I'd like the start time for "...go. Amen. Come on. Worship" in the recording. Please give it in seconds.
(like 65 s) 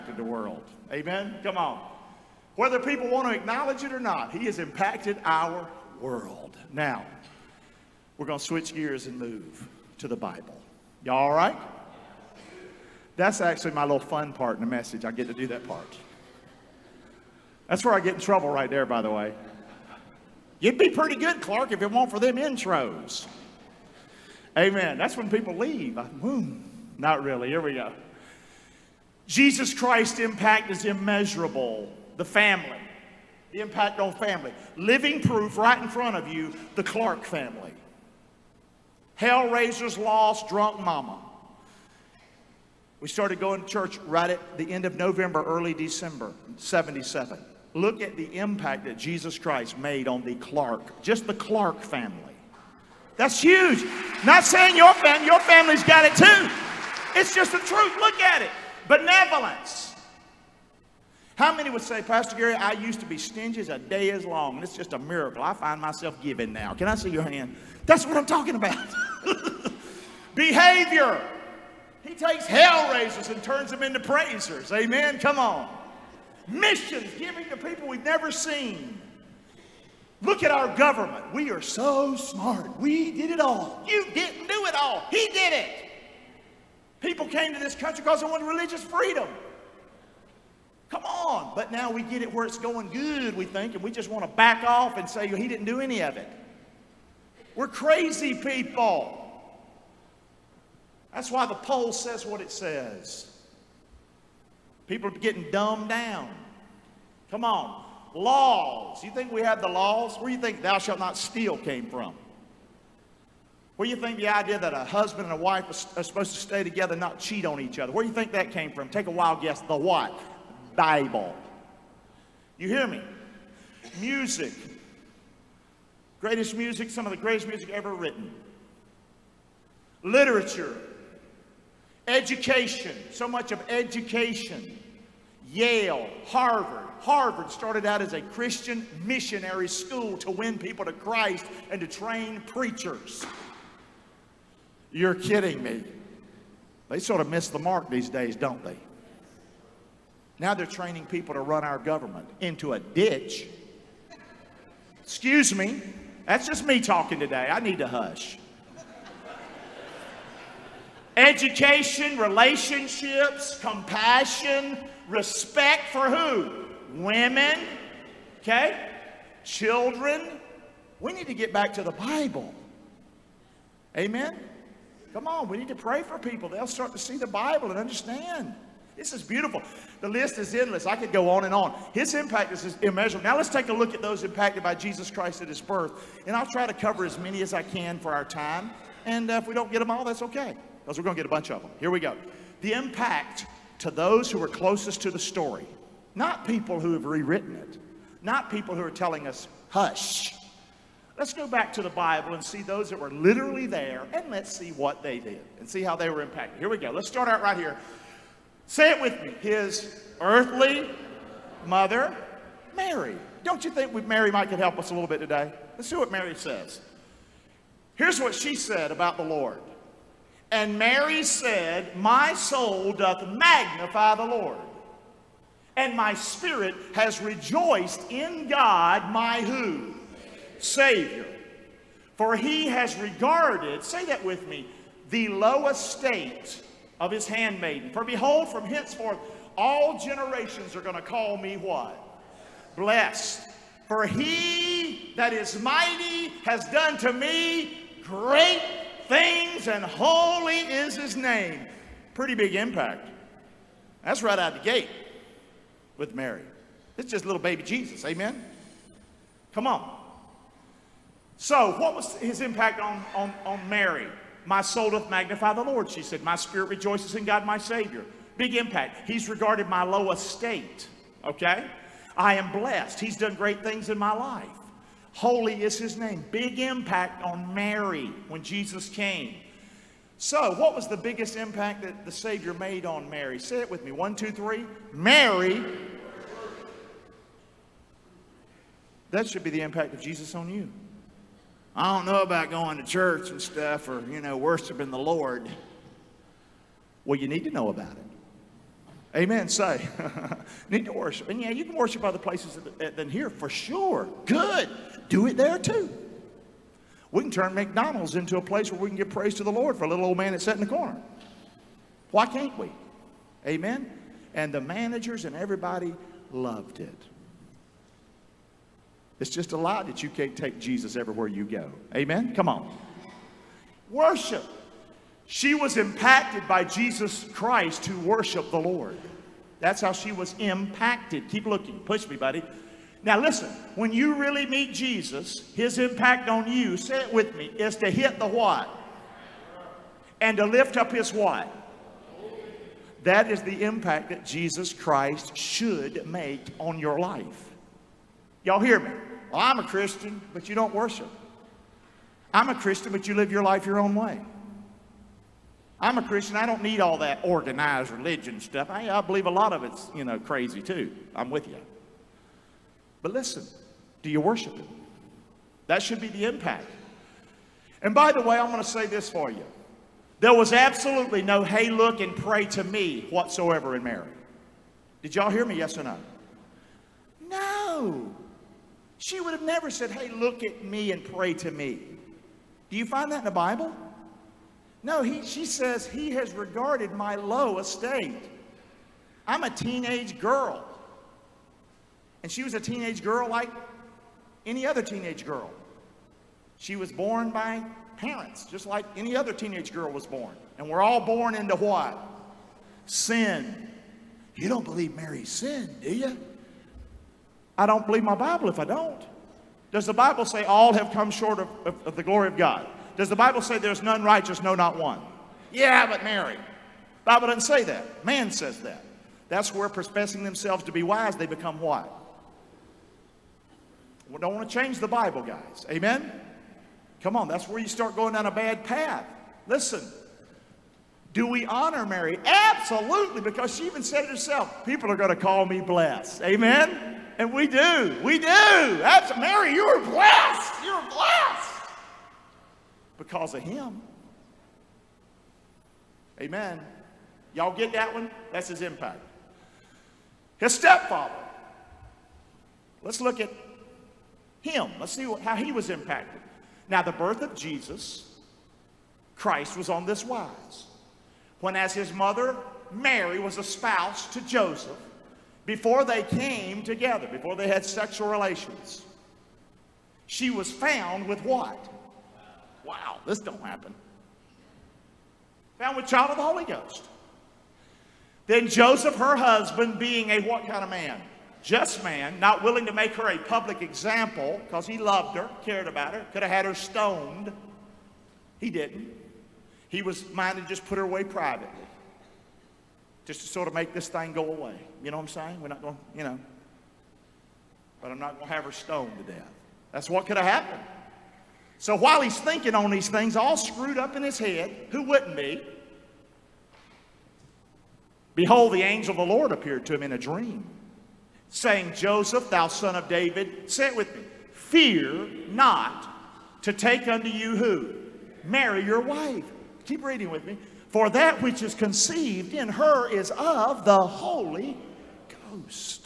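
321 s.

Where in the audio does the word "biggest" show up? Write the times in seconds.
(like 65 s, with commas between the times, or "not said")
280 s.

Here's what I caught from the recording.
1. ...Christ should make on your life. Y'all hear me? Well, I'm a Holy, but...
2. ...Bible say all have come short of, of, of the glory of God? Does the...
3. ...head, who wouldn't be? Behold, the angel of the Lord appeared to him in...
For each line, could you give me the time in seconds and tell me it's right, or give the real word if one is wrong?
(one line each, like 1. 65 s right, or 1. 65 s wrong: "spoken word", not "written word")
1. 344 s wrong: "Christian", not "Holy"
2. 409 s right
3. 504 s right.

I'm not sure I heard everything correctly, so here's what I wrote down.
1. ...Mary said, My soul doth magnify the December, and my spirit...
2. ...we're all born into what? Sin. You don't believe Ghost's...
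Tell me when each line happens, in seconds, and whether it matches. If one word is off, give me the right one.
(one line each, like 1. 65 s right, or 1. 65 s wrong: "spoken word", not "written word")
1. 220 s wrong: "Lord", not "December"
2. 400 s wrong: "Mary", not "Ghost".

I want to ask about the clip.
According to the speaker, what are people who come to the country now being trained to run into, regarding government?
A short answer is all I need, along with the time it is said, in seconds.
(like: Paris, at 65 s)
a ditch, at 152 s.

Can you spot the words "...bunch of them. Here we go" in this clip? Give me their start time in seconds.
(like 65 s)
191 s.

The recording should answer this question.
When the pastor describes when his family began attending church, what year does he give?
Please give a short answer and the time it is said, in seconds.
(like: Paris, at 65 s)
1977, at 46 s.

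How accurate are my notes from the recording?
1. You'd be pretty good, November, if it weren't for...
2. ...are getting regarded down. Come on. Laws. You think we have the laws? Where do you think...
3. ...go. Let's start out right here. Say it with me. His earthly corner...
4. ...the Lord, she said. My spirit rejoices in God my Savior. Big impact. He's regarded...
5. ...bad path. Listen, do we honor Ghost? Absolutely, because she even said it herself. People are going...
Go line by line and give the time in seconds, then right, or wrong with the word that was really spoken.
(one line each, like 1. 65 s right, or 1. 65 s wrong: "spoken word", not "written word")
1. 20 s wrong: "Clark", not "November"
2. 105 s wrong: "dumbed", not "regarded"
3. 206 s wrong: "mother", not "corner"
4. 265 s right
5. 428 s wrong: "Mary", not "Ghost".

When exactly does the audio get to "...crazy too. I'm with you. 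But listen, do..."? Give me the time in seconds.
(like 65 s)
360 s.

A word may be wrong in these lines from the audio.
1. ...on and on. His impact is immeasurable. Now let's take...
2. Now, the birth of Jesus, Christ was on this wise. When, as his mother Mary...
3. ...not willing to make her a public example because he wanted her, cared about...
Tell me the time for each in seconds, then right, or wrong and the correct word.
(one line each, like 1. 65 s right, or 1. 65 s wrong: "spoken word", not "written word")
1. 181 s right
2. 456 s right
3. 482 s wrong: "loved", not "wanted".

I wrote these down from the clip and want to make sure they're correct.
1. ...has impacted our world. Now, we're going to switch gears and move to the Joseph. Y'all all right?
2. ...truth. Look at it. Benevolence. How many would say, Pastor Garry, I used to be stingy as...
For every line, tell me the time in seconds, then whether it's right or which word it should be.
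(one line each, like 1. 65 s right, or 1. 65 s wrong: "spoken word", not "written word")
1. 4 s wrong: "Bible", not "Joseph"
2. 57 s right.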